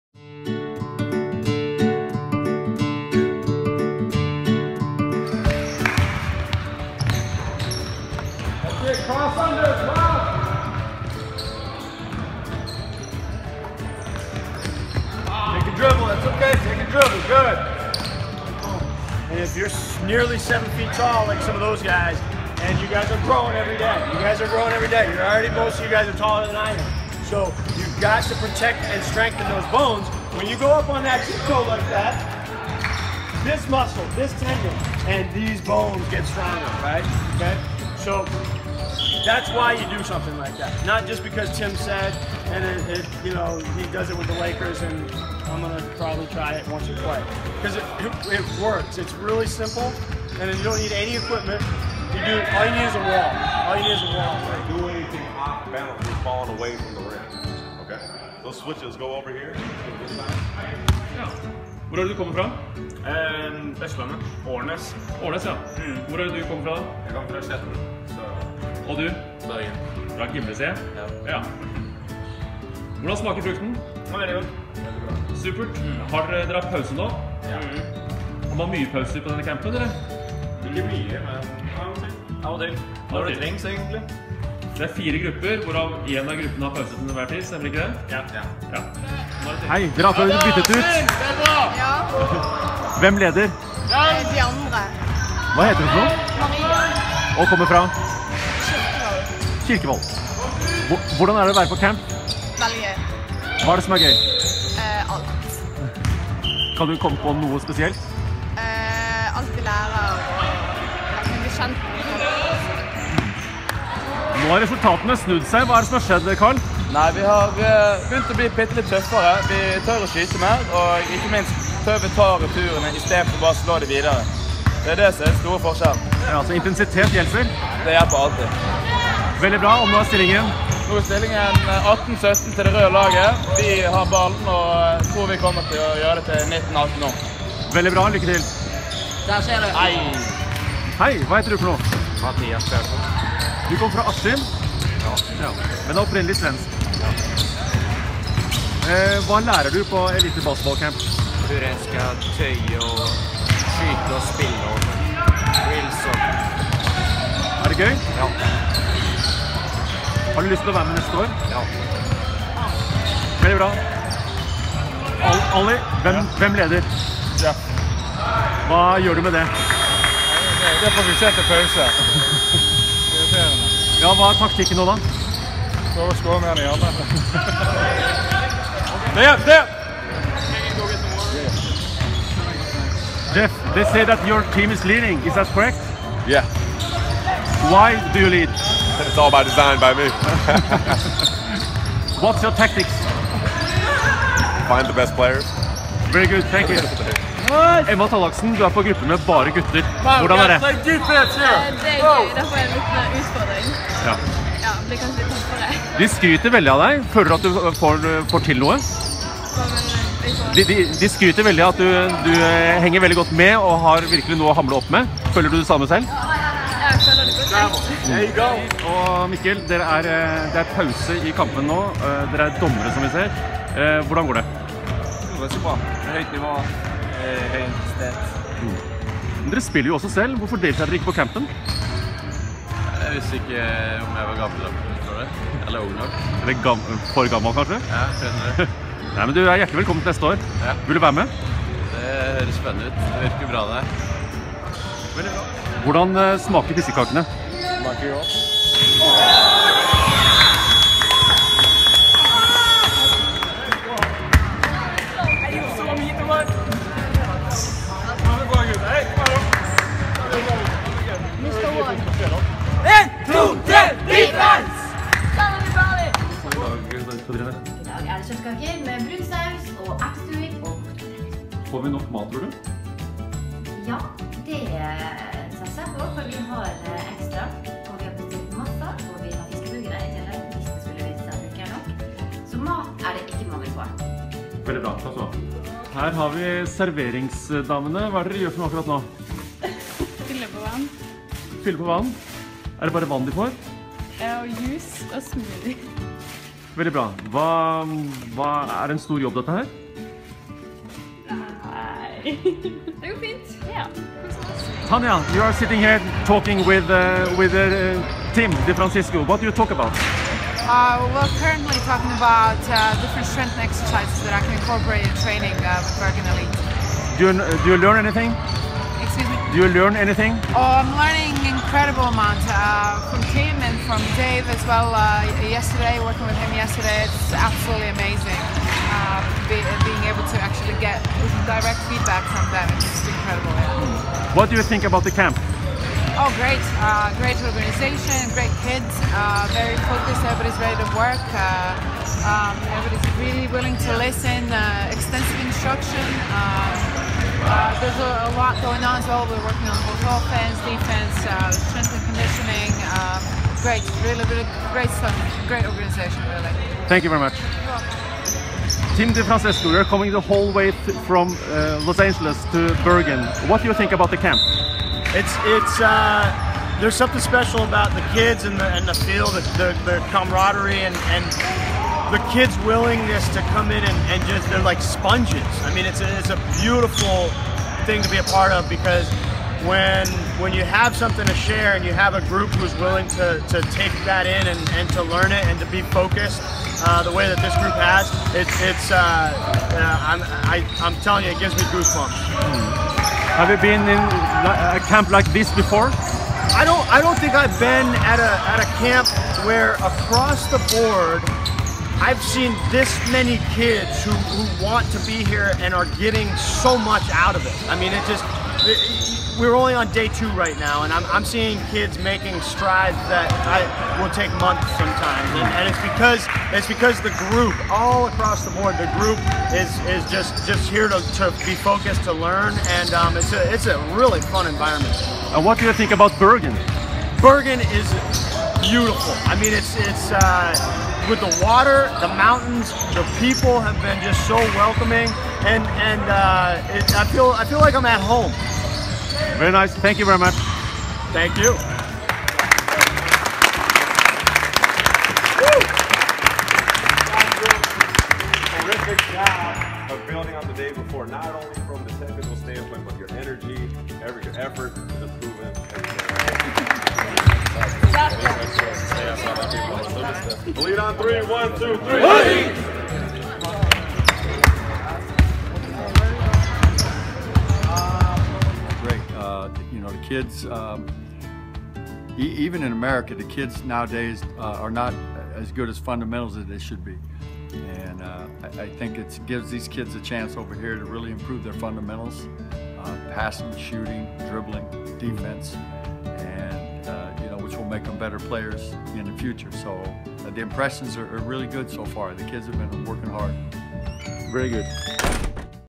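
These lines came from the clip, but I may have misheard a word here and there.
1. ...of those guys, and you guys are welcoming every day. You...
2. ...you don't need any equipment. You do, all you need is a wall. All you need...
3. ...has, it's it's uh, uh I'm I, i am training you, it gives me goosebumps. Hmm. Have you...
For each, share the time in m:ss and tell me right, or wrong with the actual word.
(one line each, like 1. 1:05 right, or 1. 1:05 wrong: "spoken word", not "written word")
1. 0:21 wrong: "growing", not "welcoming"
2. 0:50 right
3. 6:27 wrong: "telling", not "training".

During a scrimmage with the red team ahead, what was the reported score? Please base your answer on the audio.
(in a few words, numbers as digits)
18-17.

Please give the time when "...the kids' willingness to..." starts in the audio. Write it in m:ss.
6:12.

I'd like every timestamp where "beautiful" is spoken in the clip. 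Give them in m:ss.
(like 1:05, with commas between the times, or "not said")
6:16, 7:08.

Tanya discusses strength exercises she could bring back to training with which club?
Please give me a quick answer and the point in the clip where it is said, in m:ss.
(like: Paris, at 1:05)
Bergen Elite, at 5:15.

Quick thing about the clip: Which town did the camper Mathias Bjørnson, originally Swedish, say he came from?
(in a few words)
Askim.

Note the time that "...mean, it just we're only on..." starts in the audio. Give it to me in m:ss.
6:47.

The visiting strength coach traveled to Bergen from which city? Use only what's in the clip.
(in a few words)
Los Angeles.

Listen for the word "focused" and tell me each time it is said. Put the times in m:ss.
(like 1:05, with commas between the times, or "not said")
5:39, 6:25, 7:01.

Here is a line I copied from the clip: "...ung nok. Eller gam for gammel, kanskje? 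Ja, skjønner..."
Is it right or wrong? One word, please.
right.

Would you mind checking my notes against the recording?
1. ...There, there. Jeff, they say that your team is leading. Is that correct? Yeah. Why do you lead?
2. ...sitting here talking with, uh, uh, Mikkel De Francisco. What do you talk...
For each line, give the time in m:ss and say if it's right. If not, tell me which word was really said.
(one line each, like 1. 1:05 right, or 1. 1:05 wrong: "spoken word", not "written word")
1. 2:59 right
2. 5:05 wrong: "Tim", not "Mikkel".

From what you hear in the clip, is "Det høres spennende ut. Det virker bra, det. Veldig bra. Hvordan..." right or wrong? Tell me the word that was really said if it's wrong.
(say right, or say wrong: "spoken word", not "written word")
right.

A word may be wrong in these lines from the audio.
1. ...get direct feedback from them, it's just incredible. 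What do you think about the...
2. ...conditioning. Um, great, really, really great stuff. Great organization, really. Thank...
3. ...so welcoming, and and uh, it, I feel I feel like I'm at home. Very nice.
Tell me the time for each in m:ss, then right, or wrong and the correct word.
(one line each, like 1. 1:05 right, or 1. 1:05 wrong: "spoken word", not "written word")
1. 5:30 right
2. 5:52 right
3. 7:14 right.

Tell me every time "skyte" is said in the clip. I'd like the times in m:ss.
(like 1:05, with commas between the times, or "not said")
2:00, 2:33.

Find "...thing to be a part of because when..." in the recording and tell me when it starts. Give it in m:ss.
6:17.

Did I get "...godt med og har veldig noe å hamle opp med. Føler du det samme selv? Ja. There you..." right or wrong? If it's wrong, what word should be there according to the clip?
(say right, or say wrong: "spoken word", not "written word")
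wrong: "virkelig", not "veldig".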